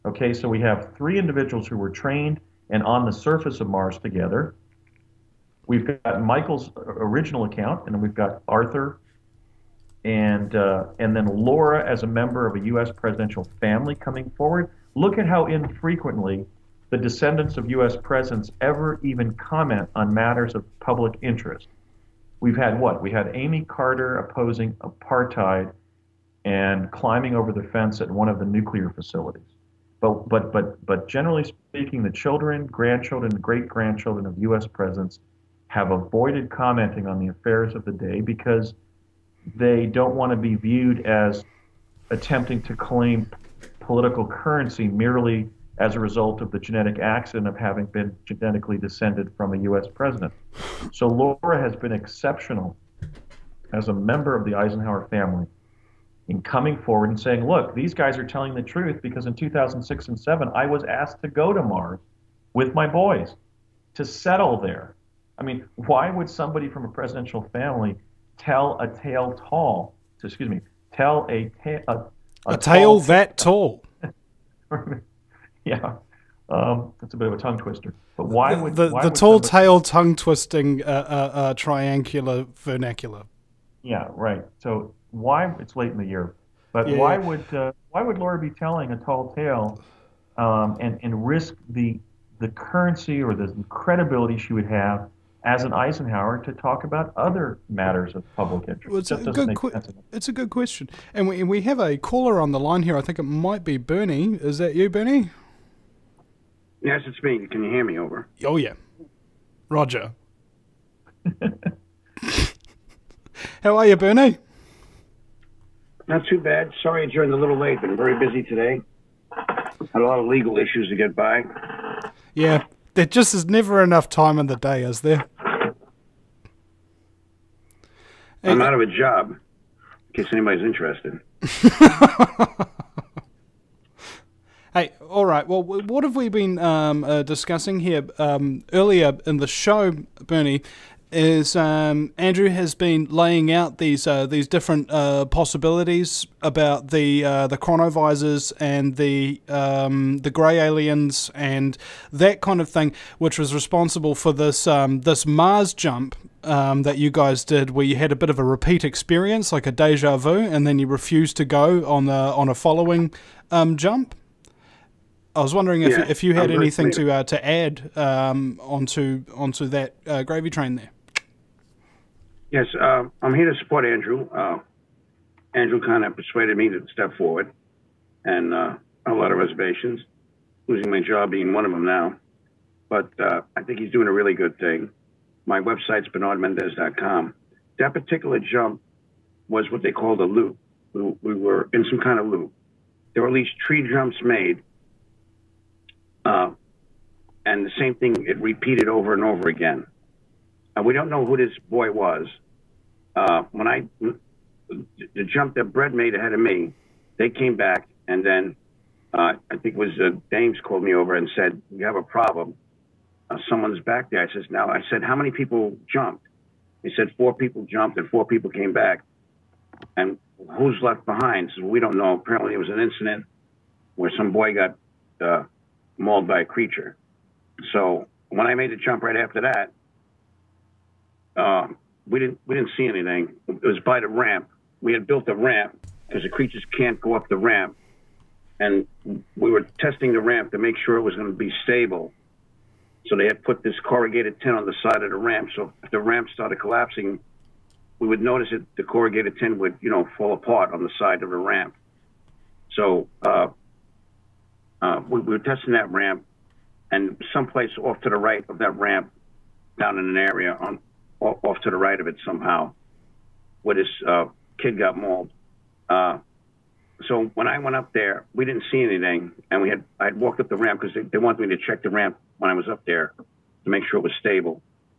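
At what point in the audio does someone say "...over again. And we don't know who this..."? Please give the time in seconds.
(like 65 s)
199 s.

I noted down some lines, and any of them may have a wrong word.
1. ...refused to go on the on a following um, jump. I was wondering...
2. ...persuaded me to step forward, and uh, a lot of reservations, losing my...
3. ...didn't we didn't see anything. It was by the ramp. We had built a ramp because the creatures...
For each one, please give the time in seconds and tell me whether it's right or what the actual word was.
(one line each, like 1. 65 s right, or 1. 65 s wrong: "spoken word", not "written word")
1. 160 s right
2. 176 s right
3. 232 s right.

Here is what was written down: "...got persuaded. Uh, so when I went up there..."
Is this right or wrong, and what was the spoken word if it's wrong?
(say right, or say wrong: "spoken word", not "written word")
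wrong: "mauled", not "persuaded".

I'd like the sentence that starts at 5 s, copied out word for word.
We've got Michael's original account, and then we've got Arthur, and uh, and then Laura as a member of a U.S.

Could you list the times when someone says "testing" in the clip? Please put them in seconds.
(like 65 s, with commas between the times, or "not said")
239 s, 255 s.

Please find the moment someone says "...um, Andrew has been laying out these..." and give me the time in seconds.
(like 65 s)
141 s.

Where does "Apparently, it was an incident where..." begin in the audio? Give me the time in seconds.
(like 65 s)
222 s.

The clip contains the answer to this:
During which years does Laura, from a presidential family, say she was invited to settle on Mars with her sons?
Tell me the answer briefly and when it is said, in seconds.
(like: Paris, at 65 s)
2006 and 2007, at 59 s.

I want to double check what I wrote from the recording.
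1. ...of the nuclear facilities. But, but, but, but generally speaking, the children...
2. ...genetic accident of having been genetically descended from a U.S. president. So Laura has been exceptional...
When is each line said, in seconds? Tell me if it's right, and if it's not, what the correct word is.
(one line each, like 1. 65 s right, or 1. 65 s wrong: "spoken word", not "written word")
1. 28 s right
2. 46 s right.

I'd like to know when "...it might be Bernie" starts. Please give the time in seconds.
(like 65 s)
103 s.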